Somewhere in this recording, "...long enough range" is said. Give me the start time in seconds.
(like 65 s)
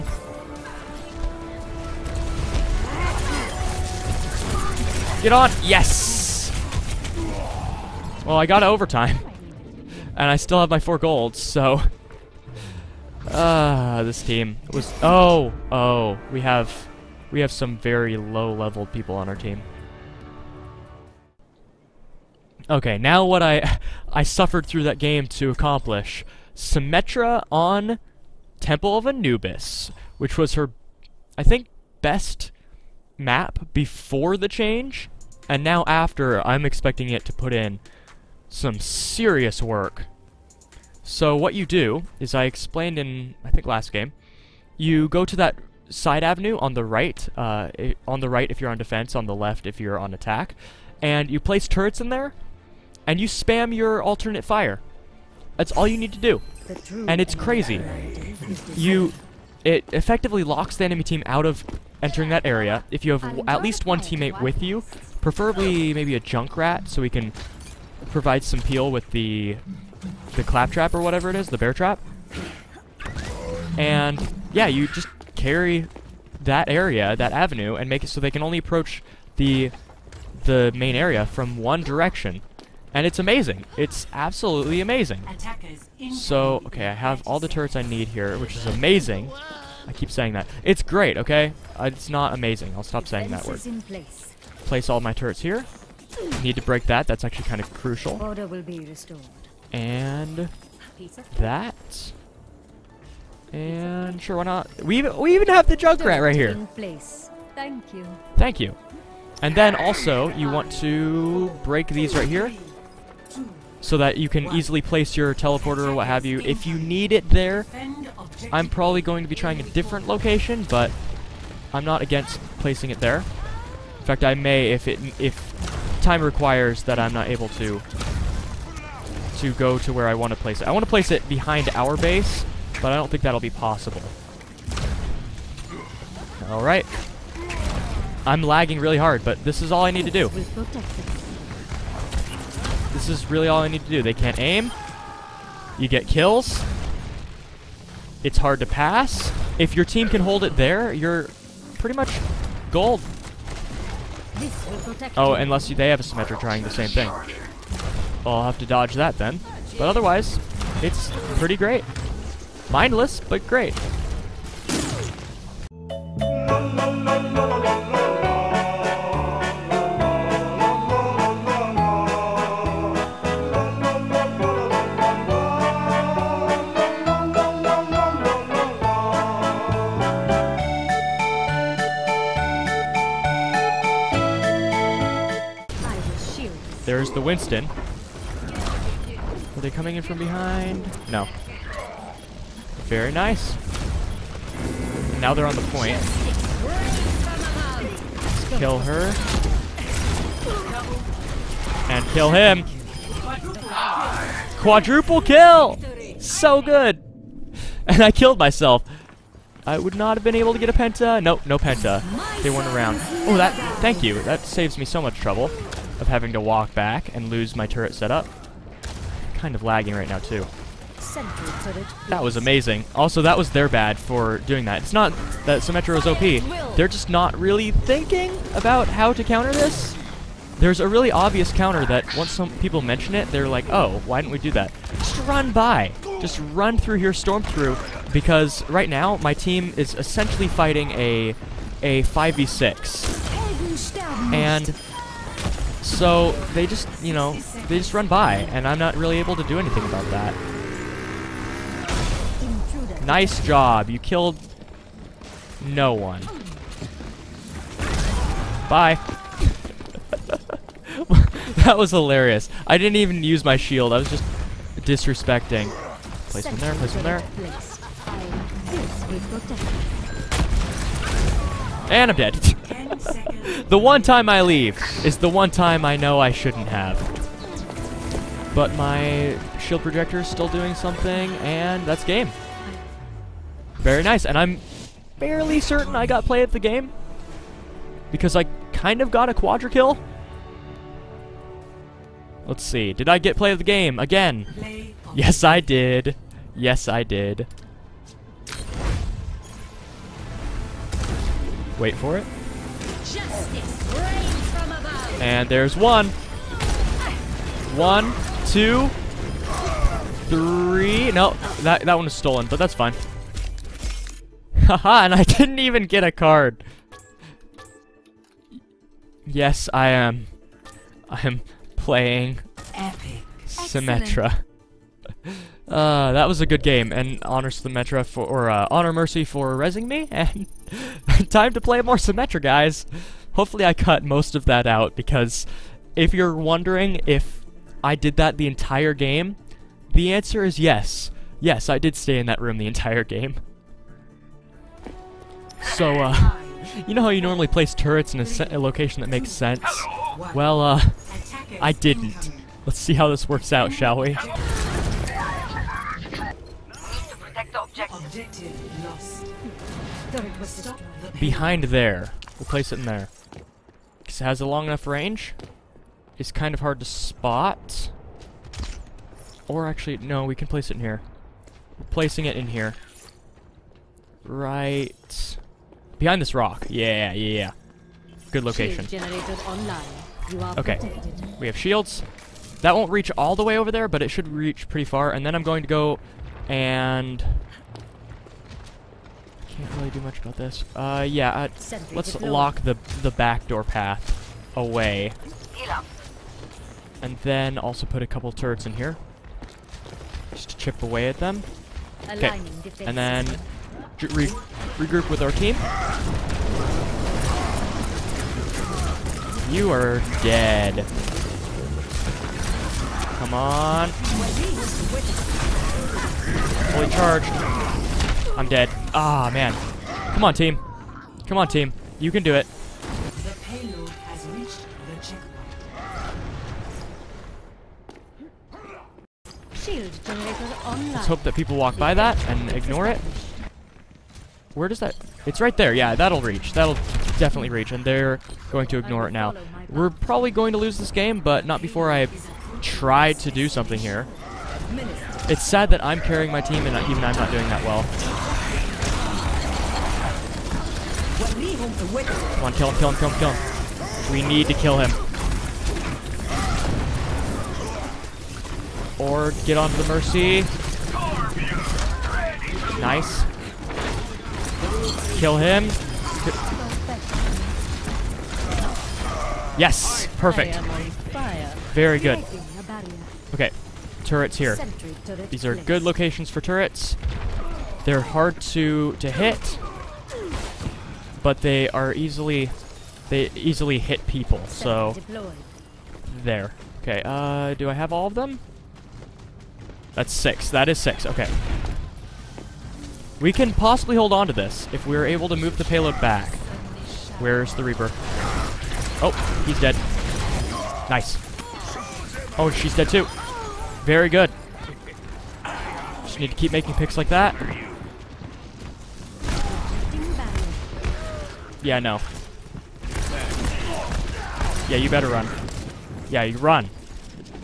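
364 s.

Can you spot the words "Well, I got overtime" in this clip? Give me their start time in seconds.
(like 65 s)
8 s.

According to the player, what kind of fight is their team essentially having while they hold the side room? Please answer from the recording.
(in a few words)
a 5v6.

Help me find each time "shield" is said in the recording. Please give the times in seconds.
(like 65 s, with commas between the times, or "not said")
263 s, 279 s, 381 s, 429 s.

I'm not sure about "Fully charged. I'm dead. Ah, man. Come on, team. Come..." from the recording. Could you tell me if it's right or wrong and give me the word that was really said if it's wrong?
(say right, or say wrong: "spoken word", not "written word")
right.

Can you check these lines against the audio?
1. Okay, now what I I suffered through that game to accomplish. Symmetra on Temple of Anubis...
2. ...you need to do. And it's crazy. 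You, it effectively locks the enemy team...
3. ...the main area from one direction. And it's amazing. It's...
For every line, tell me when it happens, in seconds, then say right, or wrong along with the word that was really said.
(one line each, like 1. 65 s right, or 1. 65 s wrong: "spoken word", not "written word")
1. 22 s right
2. 55 s right
3. 80 s right.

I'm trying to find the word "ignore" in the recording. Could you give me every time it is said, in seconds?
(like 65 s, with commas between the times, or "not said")
432 s, 438 s.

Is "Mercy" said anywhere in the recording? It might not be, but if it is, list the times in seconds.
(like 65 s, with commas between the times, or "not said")
328 s, 459 s.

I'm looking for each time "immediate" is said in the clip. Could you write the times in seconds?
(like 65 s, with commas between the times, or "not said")
not said.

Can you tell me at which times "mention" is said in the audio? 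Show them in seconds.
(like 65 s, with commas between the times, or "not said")
232 s.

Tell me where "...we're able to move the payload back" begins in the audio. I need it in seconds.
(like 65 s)
494 s.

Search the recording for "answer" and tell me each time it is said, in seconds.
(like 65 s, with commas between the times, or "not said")
340 s.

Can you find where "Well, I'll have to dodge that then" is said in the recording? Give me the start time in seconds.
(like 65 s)
158 s.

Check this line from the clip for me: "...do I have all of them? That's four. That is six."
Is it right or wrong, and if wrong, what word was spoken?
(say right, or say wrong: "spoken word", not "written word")
wrong: "six", not "four".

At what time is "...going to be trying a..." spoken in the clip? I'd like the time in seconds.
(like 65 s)
119 s.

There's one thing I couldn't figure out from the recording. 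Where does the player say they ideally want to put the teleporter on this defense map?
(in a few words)
behind our base.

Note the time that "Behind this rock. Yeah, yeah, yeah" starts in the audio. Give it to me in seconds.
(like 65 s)
375 s.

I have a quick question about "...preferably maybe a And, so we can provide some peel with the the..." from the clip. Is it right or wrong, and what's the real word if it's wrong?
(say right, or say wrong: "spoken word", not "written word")
wrong: "Junkrat", not "And".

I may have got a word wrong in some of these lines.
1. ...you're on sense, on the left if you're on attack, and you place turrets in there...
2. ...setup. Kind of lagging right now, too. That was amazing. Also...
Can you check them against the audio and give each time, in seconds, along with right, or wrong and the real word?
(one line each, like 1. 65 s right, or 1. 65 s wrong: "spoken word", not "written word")
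1. 48 s wrong: "defense", not "sense"
2. 217 s right.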